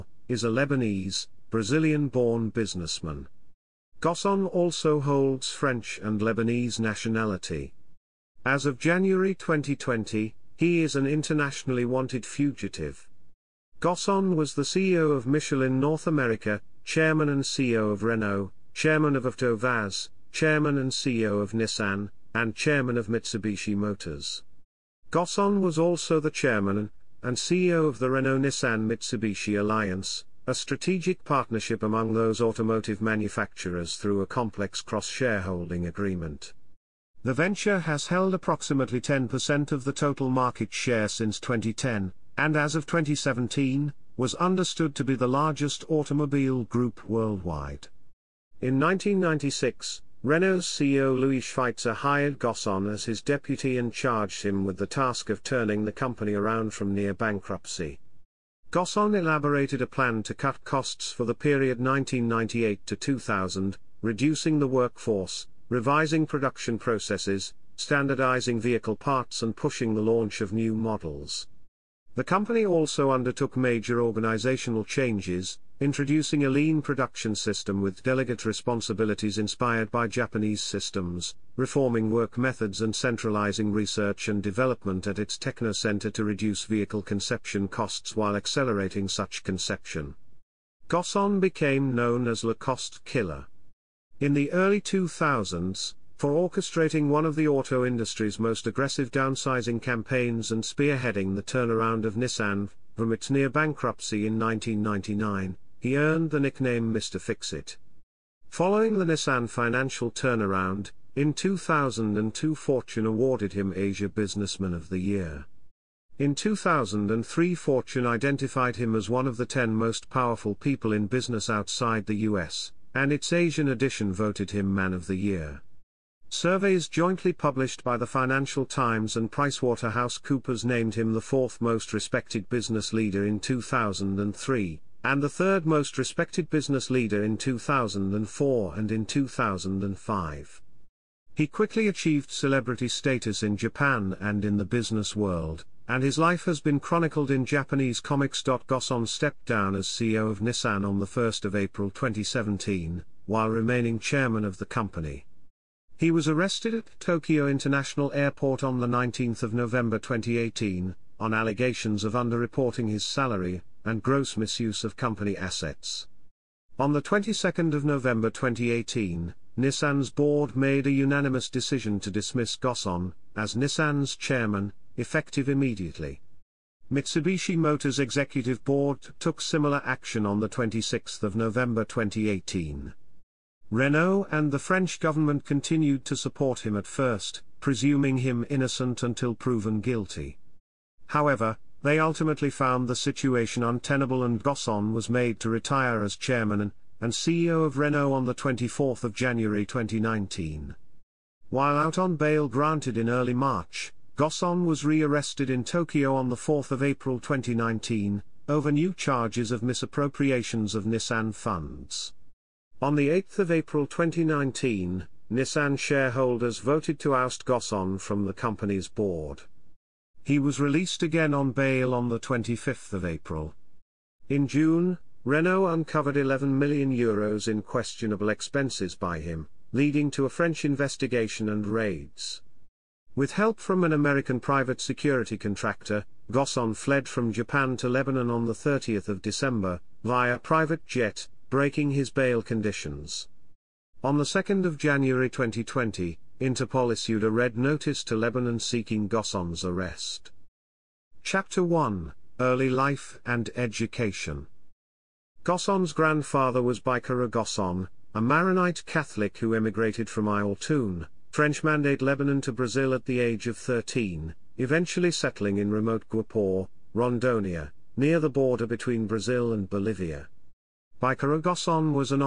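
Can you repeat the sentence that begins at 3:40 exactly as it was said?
He was released again on bail on the 25th of April.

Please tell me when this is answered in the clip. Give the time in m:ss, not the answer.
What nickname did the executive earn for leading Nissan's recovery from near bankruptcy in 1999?
1:46.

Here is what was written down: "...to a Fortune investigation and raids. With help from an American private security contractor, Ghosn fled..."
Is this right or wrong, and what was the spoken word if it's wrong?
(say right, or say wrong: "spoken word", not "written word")
wrong: "French", not "Fortune".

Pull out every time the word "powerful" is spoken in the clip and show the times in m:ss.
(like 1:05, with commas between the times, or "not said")
2:00.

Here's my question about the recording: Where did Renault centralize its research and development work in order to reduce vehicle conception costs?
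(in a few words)
Techno Center.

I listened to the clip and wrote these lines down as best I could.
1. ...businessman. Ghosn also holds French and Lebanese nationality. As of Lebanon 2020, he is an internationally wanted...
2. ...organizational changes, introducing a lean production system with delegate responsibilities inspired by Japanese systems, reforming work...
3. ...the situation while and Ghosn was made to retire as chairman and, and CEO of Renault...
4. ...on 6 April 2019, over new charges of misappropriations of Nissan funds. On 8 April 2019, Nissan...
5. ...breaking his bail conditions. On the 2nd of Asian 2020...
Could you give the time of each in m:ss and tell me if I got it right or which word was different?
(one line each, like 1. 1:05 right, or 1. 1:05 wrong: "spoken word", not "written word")
1. 0:02 wrong: "January", not "Lebanon"
2. 1:14 right
3. 3:12 wrong: "untenable", not "while"
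4. 3:26 wrong: "4", not "6"
5. 4:01 wrong: "January", not "Asian".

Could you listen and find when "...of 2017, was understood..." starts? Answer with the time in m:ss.
0:42.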